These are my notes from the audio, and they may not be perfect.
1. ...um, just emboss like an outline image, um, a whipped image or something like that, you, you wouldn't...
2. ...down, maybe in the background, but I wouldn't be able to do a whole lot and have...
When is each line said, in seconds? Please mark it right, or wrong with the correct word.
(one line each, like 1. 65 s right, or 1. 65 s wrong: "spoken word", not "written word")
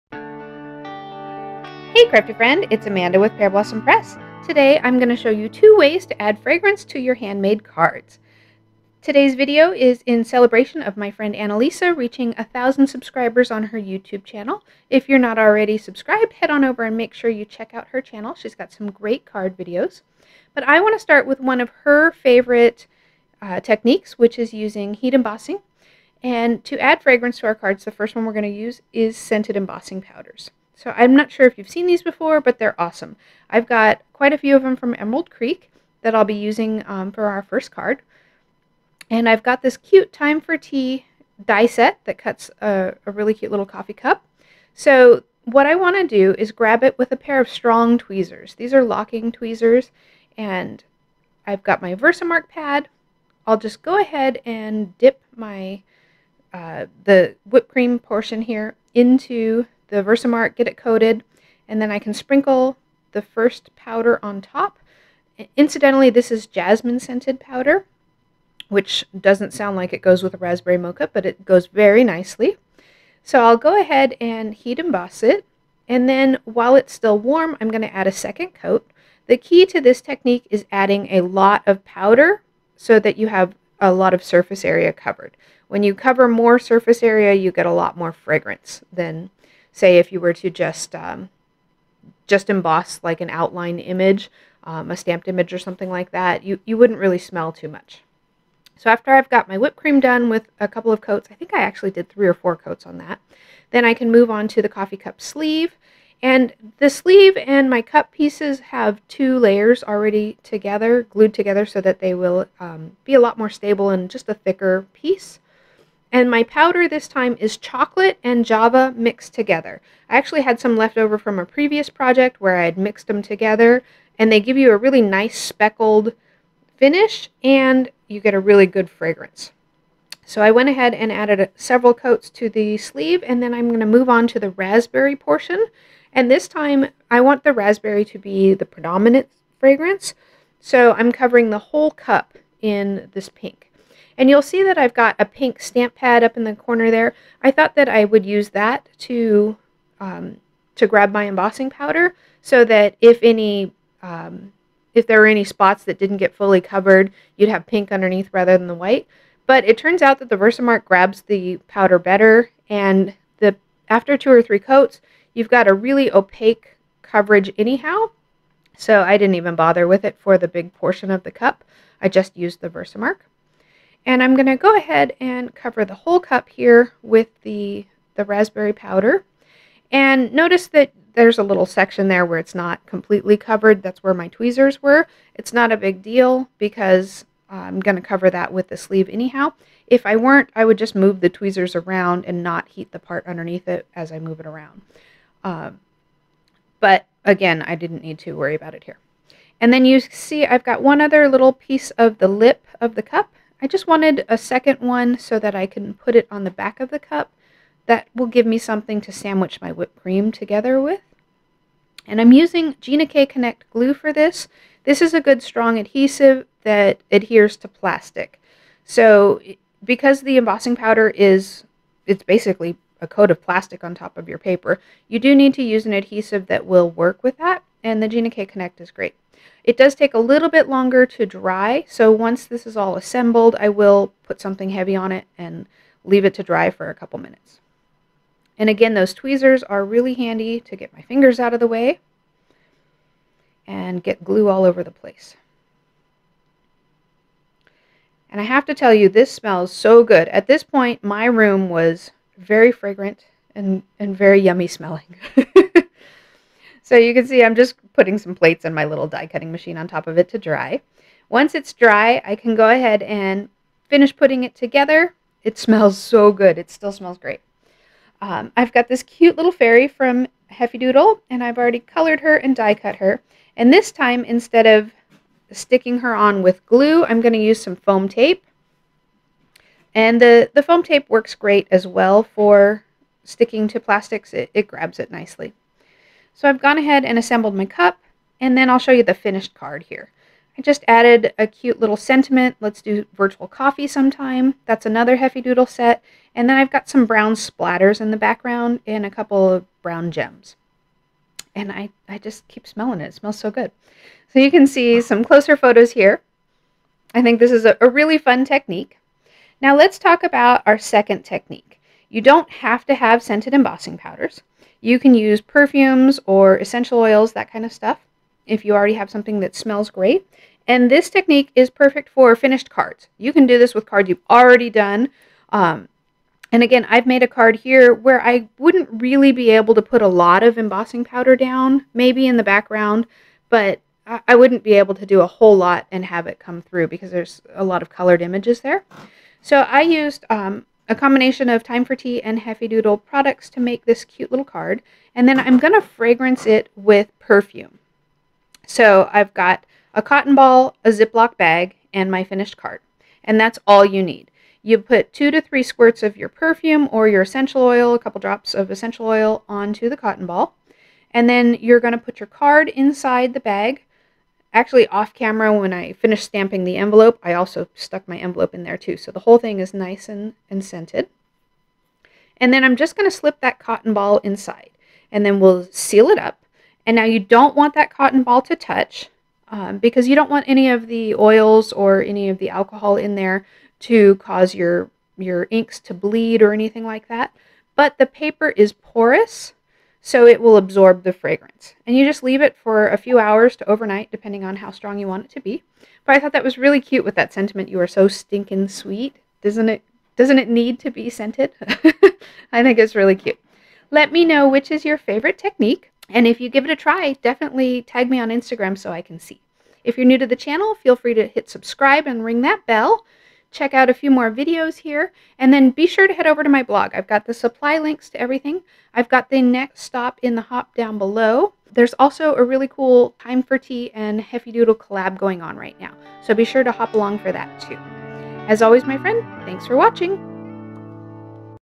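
1. 90 s wrong: "stamped", not "whipped"
2. 331 s right.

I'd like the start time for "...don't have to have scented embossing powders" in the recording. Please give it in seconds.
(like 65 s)
312 s.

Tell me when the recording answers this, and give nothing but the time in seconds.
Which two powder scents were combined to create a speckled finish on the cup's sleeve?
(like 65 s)
117 s.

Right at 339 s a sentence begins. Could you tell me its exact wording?
So I used um, a combination of Time for Tea and Heffy Doodle products to make this cute little card.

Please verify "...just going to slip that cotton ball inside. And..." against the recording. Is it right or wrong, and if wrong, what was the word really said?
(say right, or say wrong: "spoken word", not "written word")
right.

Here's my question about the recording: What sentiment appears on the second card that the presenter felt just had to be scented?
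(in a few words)
You are so stinking sweet.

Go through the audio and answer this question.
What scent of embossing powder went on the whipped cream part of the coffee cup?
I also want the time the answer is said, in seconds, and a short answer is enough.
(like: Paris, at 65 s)
Jasmine, at 66 s.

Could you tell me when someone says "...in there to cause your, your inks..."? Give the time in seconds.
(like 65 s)
382 s.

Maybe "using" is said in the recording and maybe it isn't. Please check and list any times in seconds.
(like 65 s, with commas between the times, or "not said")
24 s, 36 s, 212 s.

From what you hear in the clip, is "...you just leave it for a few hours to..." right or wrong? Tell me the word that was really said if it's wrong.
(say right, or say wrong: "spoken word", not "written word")
right.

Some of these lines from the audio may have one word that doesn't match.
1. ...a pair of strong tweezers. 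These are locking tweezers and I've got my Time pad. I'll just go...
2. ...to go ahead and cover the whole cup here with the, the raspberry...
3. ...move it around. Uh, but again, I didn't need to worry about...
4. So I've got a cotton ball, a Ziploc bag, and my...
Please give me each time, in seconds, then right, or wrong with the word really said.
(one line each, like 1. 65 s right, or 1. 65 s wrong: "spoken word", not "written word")
1. 47 s wrong: "Versamark", not "Time"
2. 174 s right
3. 194 s right
4. 348 s right.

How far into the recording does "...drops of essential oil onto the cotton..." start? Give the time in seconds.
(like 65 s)
358 s.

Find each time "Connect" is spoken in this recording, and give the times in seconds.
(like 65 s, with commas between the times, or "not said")
213 s, 228 s.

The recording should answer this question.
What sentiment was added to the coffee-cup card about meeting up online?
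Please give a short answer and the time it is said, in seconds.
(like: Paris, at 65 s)
Let's do virtual coffee sometime, at 292 s.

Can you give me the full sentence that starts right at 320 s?
And this technique is perfect for finished cards.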